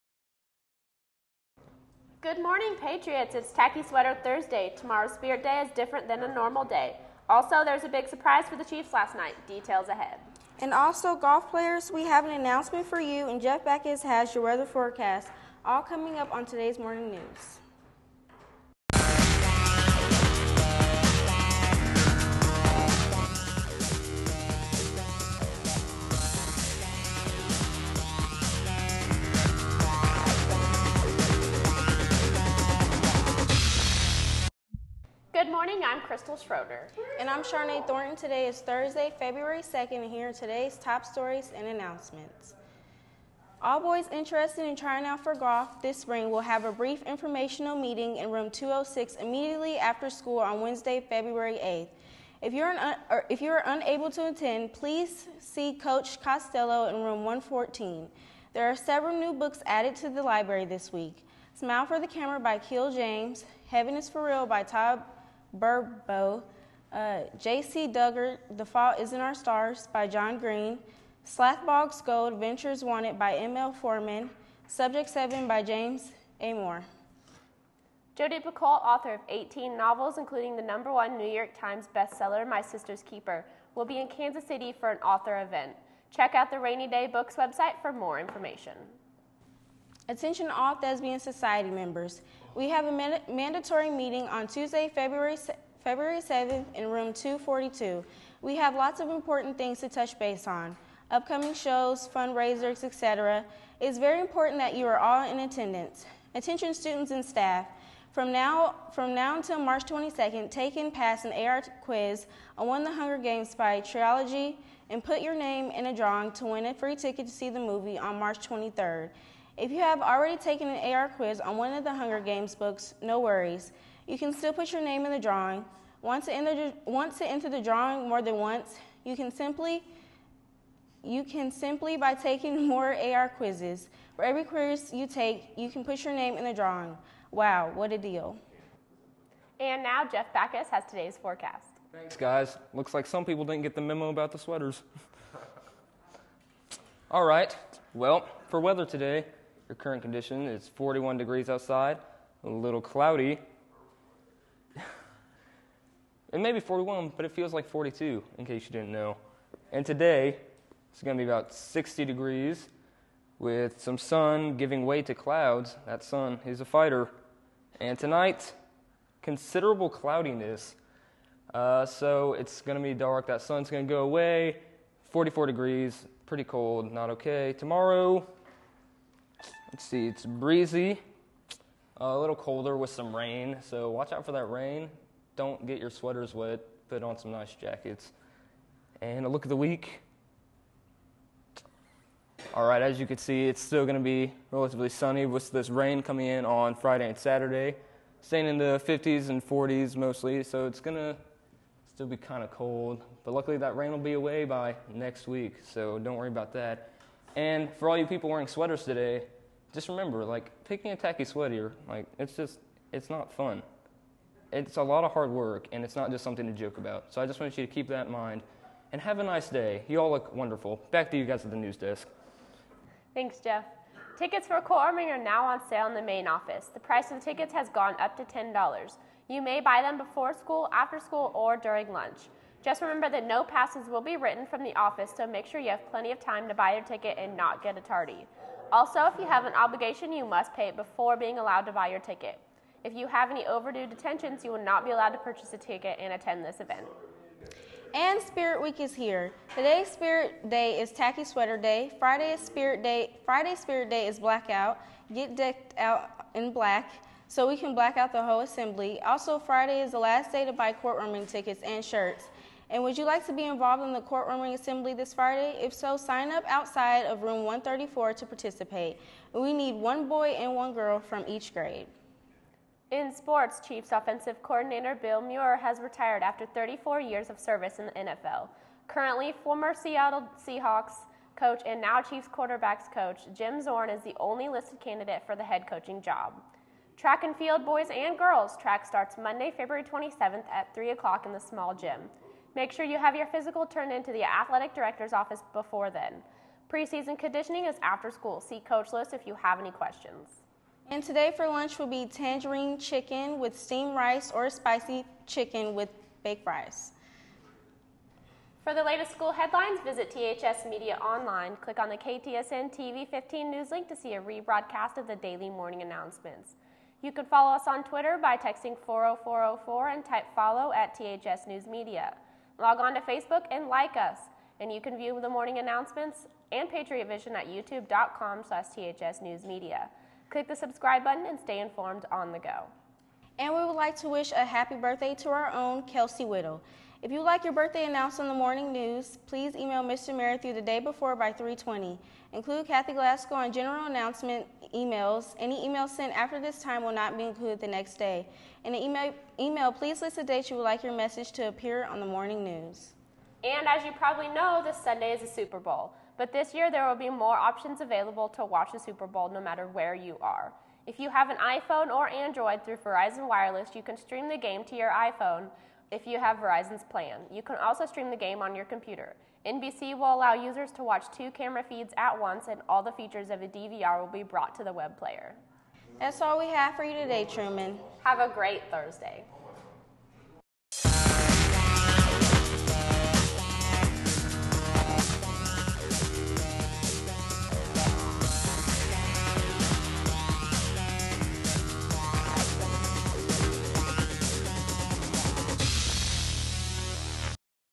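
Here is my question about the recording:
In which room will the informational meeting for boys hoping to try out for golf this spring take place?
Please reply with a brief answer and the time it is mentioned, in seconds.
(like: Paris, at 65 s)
Room 206, at 48 s.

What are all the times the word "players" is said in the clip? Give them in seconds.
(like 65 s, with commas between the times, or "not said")
11 s, 374 s.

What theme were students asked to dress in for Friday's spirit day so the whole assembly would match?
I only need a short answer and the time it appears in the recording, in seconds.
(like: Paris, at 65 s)
Blackout, at 254 s.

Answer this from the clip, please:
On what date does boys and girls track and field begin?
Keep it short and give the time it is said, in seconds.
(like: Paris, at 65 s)
February 27th, at 289 s.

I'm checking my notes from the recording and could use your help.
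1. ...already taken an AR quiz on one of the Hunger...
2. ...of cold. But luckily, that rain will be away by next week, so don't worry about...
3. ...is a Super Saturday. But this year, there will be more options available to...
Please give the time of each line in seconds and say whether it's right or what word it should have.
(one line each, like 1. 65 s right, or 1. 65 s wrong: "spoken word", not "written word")
1. 120 s right
2. 202 s right
3. 355 s wrong: "Bowl", not "Saturday".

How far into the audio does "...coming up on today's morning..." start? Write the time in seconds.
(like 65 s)
15 s.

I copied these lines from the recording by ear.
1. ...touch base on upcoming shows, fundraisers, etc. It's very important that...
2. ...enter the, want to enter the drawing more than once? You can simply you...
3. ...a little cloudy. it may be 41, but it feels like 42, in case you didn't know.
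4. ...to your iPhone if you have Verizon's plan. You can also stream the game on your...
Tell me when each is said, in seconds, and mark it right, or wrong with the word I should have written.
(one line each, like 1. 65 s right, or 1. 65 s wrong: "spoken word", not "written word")
1. 99 s right
2. 126 s right
3. 152 s right
4. 364 s right.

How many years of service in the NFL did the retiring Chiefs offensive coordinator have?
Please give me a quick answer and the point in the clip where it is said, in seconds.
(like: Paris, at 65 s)
34, at 276 s.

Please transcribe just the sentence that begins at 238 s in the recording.
Also, if you have an obligation, you must pay it before being allowed to buy your ticket.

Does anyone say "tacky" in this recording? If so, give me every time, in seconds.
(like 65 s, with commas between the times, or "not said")
3 s, 210 s, 250 s.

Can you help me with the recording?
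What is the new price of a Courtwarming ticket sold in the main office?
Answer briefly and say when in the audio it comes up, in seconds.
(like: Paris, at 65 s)
$10, at 228 s.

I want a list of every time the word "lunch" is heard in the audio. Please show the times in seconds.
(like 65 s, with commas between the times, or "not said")
231 s, 301 s.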